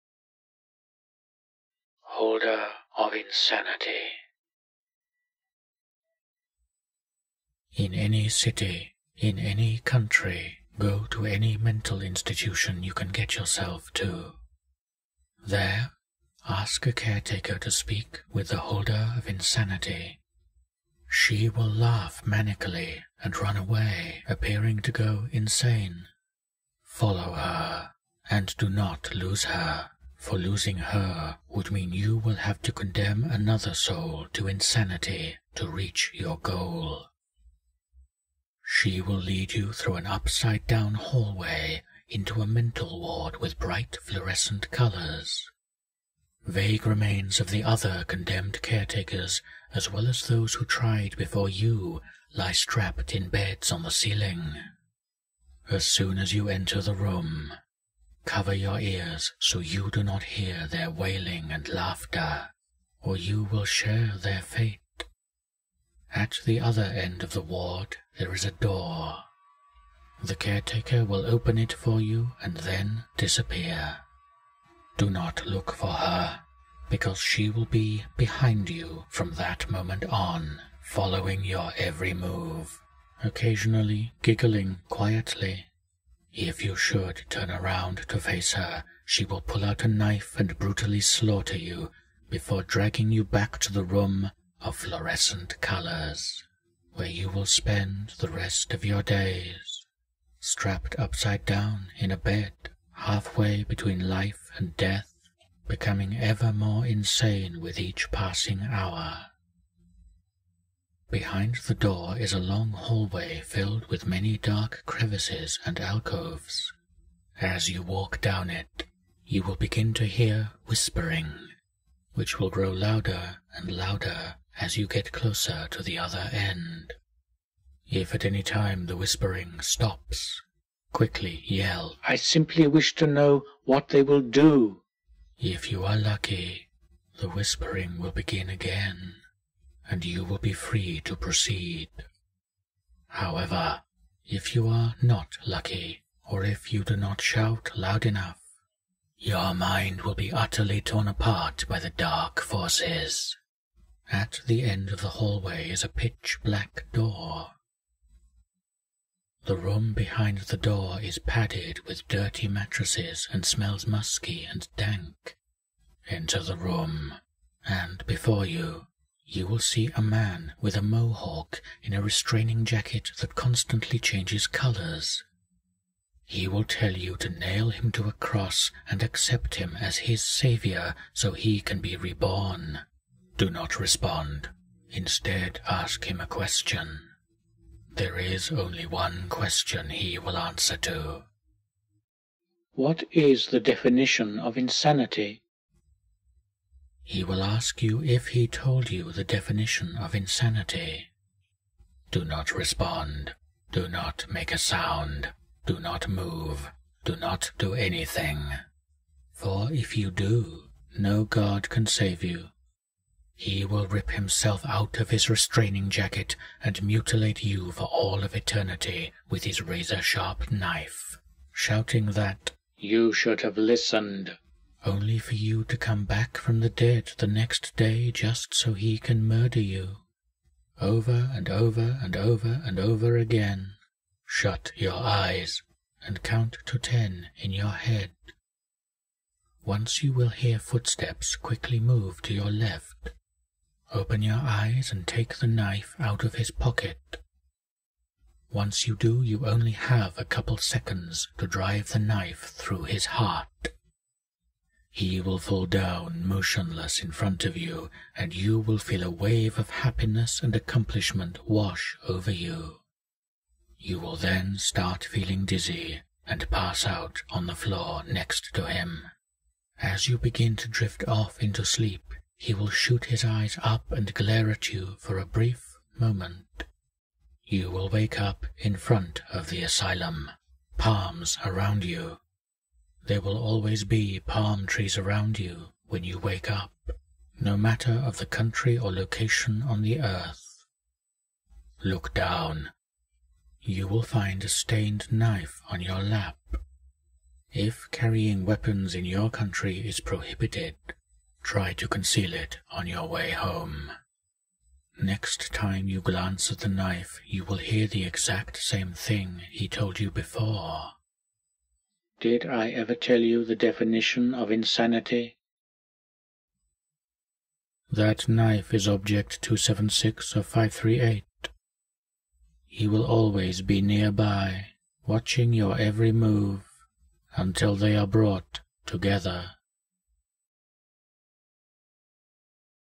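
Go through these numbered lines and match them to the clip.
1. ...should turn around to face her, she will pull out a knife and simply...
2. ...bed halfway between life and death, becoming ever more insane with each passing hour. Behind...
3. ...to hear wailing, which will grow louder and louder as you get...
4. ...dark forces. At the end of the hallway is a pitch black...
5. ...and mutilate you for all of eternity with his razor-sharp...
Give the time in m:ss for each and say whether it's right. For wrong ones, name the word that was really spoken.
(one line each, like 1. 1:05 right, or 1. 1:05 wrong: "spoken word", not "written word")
1. 1:26 wrong: "brutally", not "simply"
2. 1:42 right
3. 1:59 wrong: "whispering", not "wailing"
4. 2:31 right
5. 3:36 right.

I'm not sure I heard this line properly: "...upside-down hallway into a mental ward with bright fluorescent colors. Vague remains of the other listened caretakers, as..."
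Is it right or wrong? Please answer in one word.
wrong.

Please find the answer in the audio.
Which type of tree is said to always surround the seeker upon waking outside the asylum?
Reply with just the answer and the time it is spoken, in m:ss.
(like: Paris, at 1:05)
Palm trees, at 4:44.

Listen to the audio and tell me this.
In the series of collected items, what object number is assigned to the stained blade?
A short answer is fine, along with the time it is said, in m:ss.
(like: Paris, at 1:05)
276, at 5:19.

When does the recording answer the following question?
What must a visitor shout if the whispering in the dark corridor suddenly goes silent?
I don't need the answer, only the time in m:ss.
2:12.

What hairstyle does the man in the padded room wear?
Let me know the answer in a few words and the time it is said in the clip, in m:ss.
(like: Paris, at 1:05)
Mohawk, at 2:50.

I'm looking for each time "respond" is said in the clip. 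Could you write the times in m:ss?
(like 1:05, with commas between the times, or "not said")
3:03, 3:22.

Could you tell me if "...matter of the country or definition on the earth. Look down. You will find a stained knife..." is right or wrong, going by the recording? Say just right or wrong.
wrong.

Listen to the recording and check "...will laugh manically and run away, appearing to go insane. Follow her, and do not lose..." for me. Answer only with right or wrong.
right.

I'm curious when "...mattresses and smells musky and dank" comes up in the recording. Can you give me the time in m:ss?
2:42.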